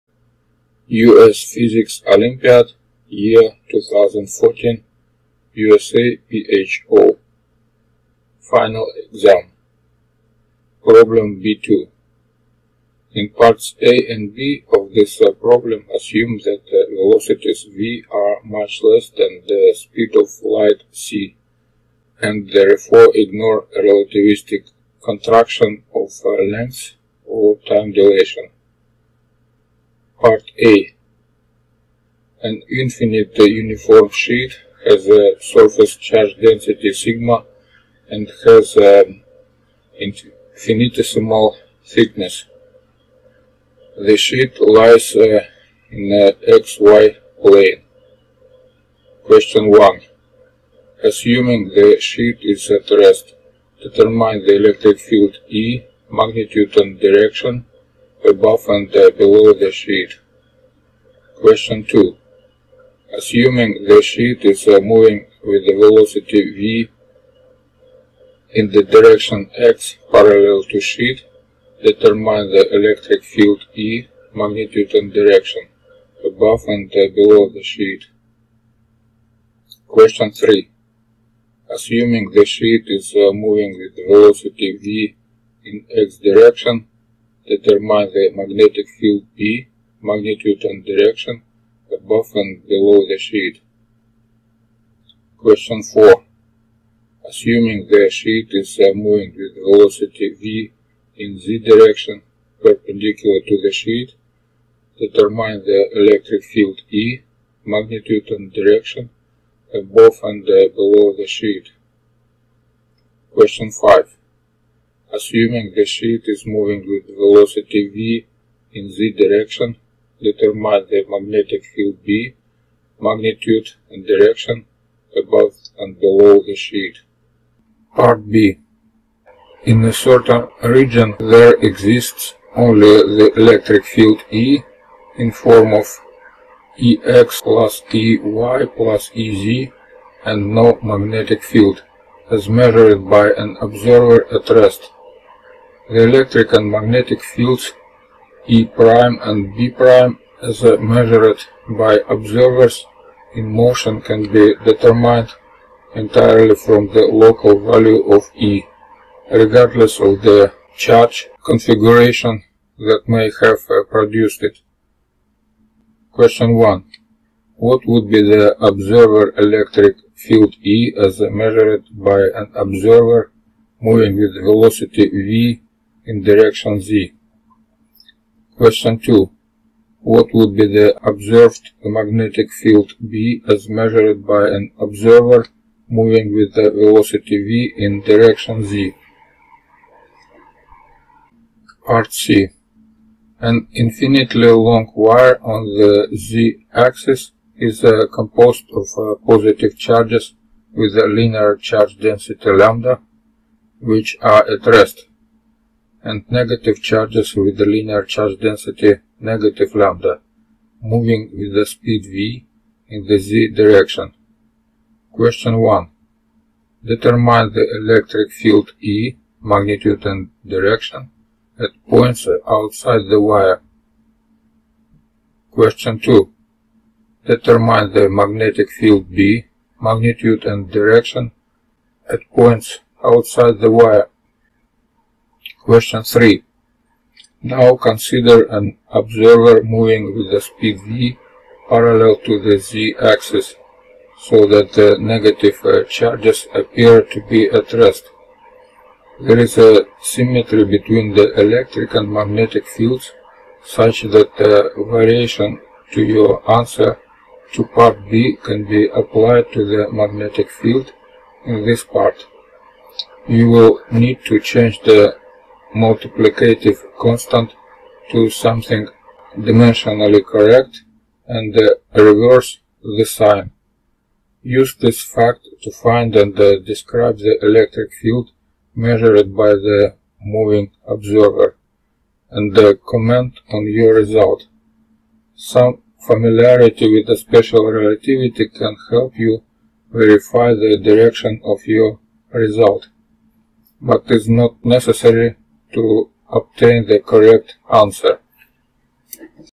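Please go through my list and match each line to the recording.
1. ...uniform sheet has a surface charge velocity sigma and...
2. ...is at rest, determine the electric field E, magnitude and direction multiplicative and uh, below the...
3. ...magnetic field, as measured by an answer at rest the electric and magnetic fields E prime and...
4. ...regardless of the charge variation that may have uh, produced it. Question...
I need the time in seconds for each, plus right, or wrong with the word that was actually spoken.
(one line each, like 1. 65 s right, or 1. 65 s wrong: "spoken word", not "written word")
1. 33 s wrong: "density", not "velocity"
2. 52 s wrong: "above", not "multiplicative"
3. 140 s wrong: "observer", not "answer"
4. 159 s wrong: "configuration", not "variation".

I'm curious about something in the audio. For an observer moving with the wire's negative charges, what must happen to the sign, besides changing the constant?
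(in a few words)
reverse the sign.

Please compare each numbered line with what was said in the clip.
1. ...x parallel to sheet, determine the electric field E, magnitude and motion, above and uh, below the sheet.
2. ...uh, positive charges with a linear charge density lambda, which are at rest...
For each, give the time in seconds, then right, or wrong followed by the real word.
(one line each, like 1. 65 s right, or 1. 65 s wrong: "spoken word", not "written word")
1. 69 s wrong: "direction", not "motion"
2. 198 s right.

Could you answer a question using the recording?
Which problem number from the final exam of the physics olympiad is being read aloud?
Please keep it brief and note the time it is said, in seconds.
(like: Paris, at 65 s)
B2, at 10 s.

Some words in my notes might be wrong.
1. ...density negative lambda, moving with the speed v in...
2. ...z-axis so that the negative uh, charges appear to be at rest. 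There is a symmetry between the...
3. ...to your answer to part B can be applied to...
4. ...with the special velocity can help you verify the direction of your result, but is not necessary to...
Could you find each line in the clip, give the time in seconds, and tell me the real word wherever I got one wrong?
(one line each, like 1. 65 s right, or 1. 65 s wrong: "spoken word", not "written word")
1. 208 s right
2. 242 s right
3. 255 s right
4. 286 s wrong: "relativity", not "velocity".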